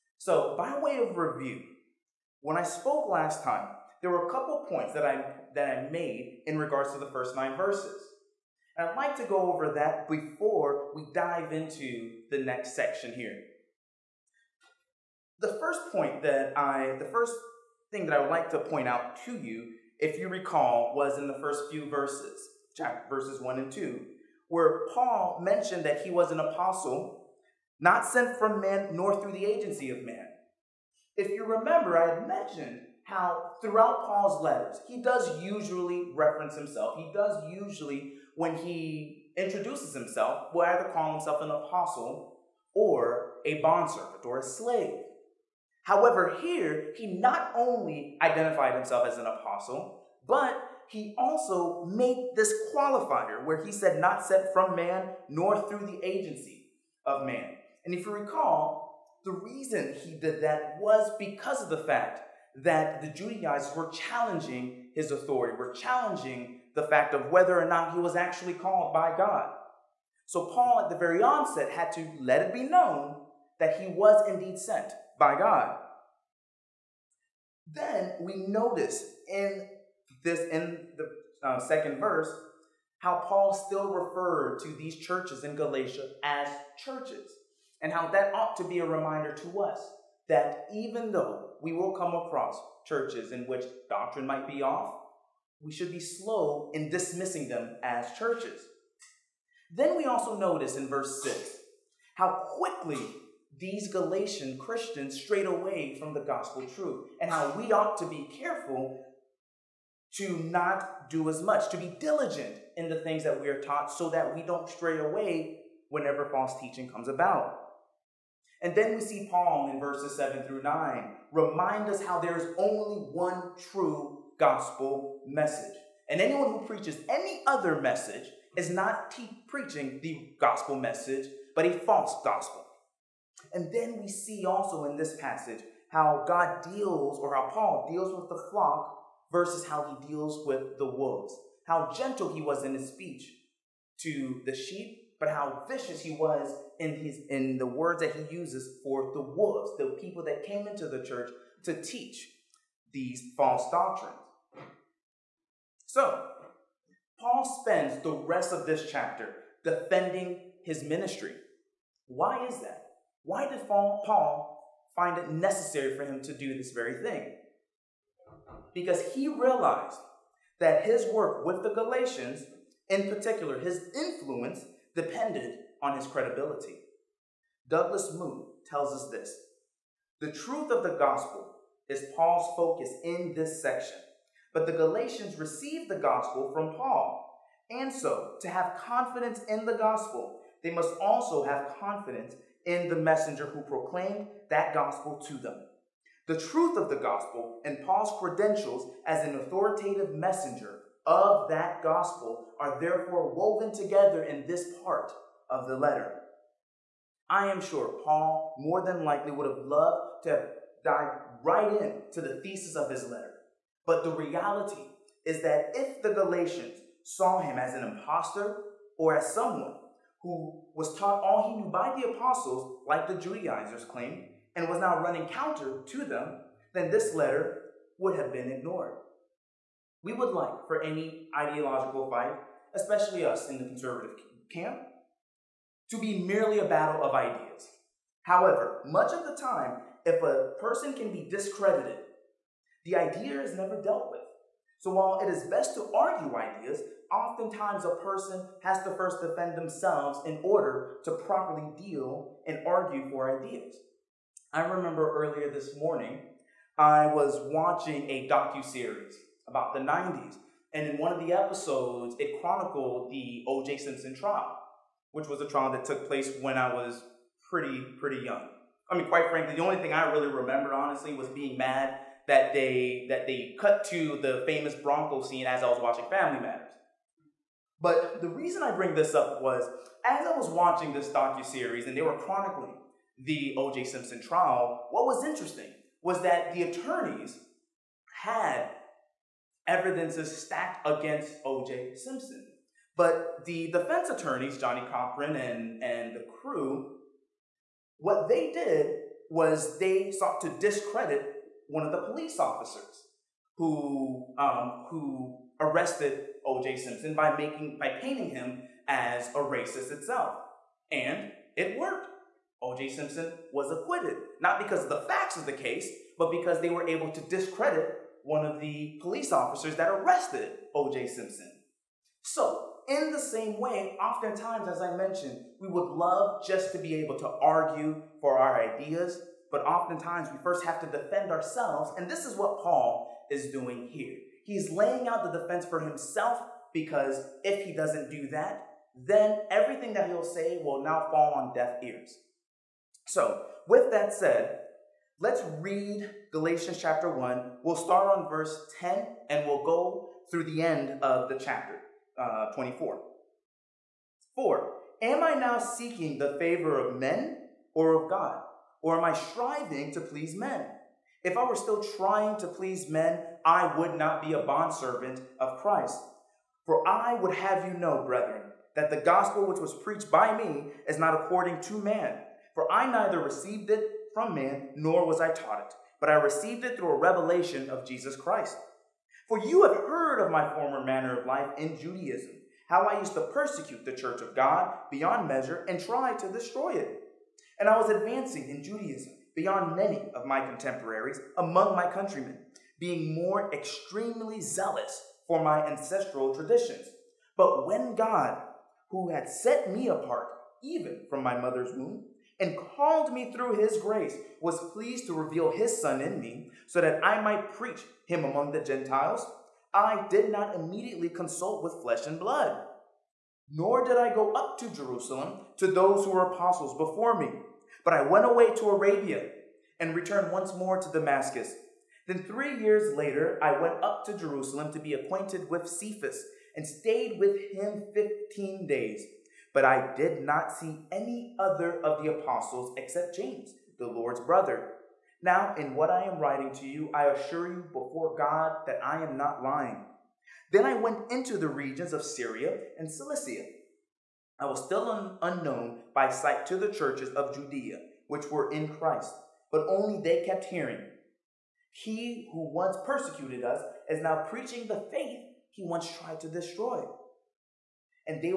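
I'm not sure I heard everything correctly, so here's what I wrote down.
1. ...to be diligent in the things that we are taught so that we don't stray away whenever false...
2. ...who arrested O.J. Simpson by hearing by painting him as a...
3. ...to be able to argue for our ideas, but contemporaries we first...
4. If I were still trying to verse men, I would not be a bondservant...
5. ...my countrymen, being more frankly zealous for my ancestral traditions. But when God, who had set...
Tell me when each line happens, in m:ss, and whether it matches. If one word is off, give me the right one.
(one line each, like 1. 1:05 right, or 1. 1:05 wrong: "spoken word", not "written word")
1. 1:51 right
2. 5:04 wrong: "making", not "hearing"
3. 5:26 wrong: "oftentimes", not "contemporaries"
4. 6:01 wrong: "please", not "verse"
5. 6:31 wrong: "extremely", not "frankly".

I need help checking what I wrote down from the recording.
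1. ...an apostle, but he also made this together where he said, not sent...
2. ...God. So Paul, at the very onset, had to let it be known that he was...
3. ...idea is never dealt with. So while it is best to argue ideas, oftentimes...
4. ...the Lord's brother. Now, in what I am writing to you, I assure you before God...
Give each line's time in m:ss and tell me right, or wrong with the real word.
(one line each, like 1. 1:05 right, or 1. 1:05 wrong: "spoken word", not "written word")
1. 0:49 wrong: "qualifier", not "together"
2. 1:09 right
3. 4:02 right
4. 7:13 right.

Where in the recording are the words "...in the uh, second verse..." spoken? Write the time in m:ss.
1:20.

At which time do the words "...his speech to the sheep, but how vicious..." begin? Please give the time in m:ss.
2:22.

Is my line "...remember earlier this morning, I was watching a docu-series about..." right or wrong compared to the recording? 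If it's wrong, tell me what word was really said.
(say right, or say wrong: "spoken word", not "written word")
right.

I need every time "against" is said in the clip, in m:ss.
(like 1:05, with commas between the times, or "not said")
4:50.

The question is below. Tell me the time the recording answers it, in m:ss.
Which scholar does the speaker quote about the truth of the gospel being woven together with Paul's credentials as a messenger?
2:57.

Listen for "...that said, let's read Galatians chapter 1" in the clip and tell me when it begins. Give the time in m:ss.
5:43.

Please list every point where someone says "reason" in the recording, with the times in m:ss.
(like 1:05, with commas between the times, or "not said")
0:59, 4:38.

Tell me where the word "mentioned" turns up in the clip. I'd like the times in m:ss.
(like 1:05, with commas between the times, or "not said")
0:25, 0:32, 5:24.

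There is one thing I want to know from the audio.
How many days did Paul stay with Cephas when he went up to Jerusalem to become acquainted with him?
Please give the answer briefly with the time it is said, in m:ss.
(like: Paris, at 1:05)
15, at 7:07.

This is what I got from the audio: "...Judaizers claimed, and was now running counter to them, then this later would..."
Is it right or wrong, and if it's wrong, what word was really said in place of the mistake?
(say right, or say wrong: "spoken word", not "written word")
wrong: "letter", not "later".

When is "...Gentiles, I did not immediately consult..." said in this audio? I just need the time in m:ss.
6:48.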